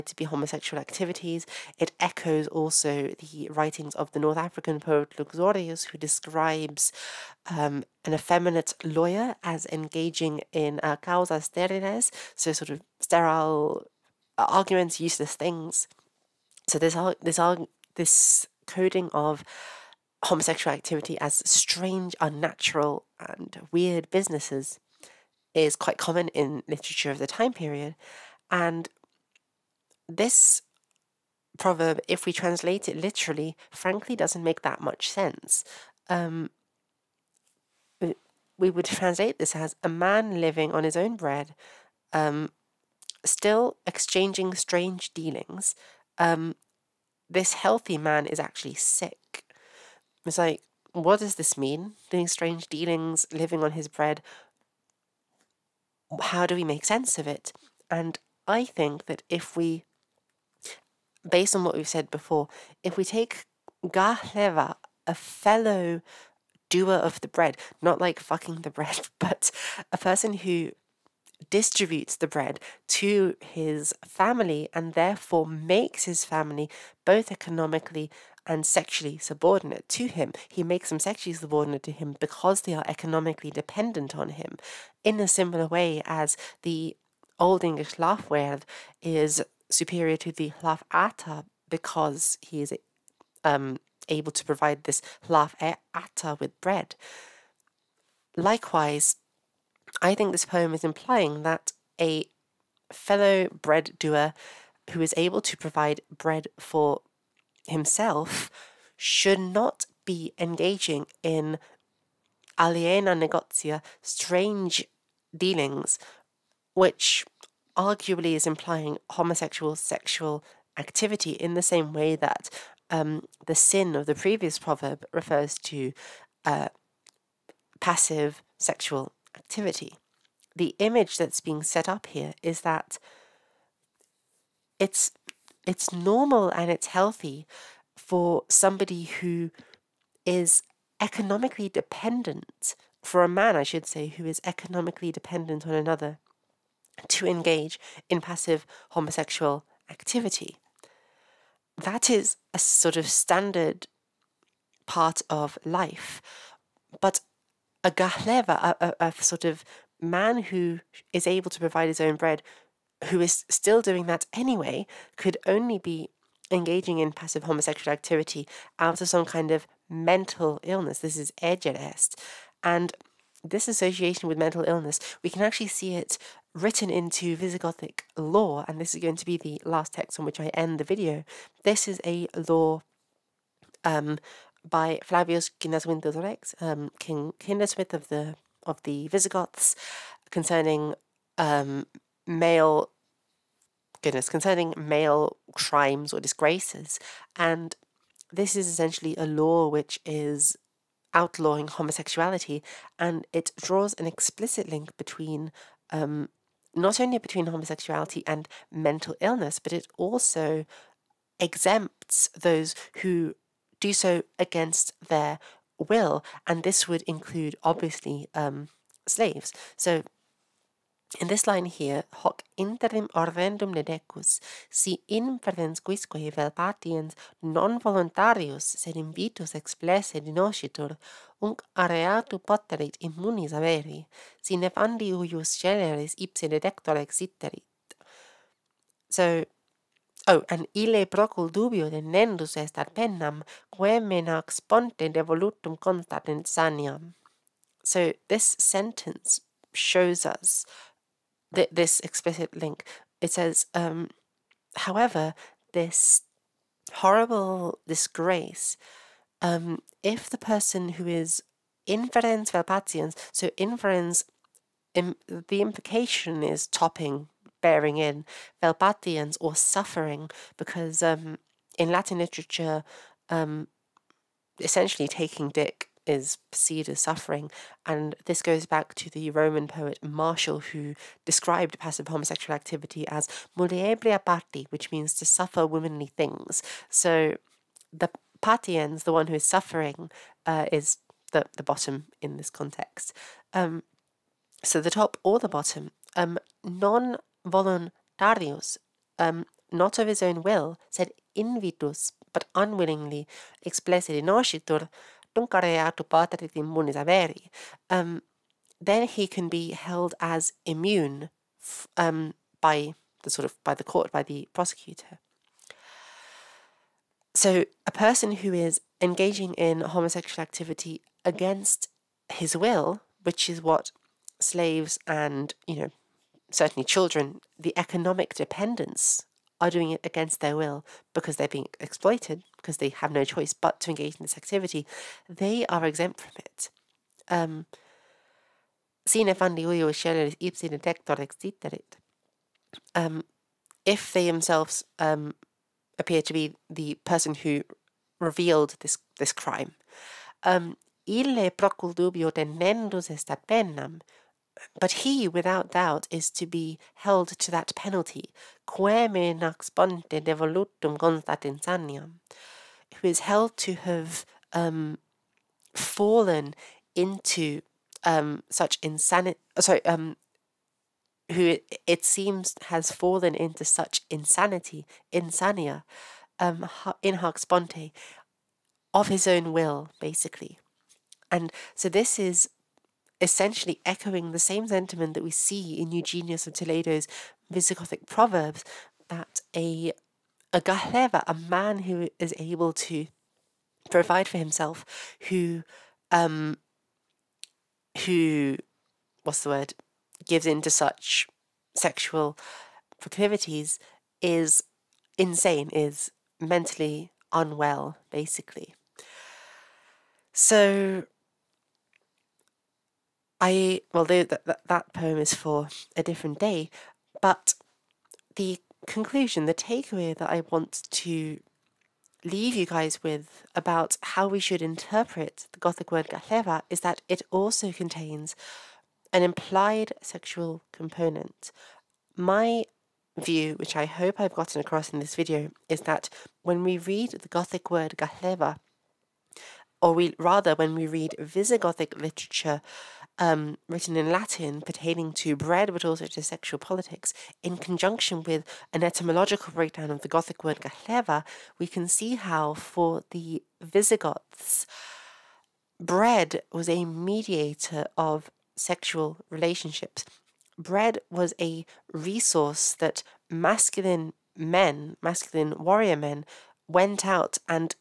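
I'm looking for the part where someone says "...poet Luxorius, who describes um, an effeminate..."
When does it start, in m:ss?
0:04.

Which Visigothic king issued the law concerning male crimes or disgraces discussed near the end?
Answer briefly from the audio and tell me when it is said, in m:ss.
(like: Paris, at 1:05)
Chindaswinth, at 3:06.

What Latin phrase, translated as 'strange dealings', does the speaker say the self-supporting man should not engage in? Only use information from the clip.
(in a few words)
aliena negotia.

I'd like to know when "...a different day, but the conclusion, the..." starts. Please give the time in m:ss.
6:55.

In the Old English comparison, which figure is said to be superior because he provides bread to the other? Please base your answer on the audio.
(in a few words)
Lafwerd.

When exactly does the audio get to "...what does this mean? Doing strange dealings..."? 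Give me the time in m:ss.
0:50.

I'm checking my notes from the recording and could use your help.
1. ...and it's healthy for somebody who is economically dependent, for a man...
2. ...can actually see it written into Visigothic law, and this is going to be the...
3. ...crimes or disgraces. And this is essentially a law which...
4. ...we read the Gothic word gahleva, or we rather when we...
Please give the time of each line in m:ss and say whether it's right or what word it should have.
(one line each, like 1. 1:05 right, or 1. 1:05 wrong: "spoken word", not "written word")
1. 2:16 right
2. 2:55 right
3. 3:15 right
4. 7:16 right.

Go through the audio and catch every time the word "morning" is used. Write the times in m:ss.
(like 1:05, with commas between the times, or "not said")
not said.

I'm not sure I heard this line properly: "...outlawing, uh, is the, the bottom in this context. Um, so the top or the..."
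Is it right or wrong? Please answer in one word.
wrong.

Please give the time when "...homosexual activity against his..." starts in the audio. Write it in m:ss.
5:19.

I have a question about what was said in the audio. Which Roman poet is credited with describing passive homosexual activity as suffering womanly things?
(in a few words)
Martial.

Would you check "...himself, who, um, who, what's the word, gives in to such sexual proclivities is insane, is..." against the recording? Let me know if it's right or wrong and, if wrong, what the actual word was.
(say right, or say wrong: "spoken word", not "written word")
right.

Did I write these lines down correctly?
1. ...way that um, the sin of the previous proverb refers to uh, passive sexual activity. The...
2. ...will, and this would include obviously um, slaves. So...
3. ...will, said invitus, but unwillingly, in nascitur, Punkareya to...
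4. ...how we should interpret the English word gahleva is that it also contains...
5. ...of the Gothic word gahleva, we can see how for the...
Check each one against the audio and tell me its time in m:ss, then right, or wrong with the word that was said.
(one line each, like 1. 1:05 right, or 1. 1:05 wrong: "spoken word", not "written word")
1. 2:01 right
2. 3:35 right
3. 5:00 right
4. 7:04 wrong: "Gothic", not "English"
5. 7:29 right.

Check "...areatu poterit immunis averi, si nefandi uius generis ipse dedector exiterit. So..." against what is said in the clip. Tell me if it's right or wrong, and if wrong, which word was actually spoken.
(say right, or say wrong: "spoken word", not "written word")
right.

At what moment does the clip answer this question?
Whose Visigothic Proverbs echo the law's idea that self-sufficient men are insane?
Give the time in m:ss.
6:25.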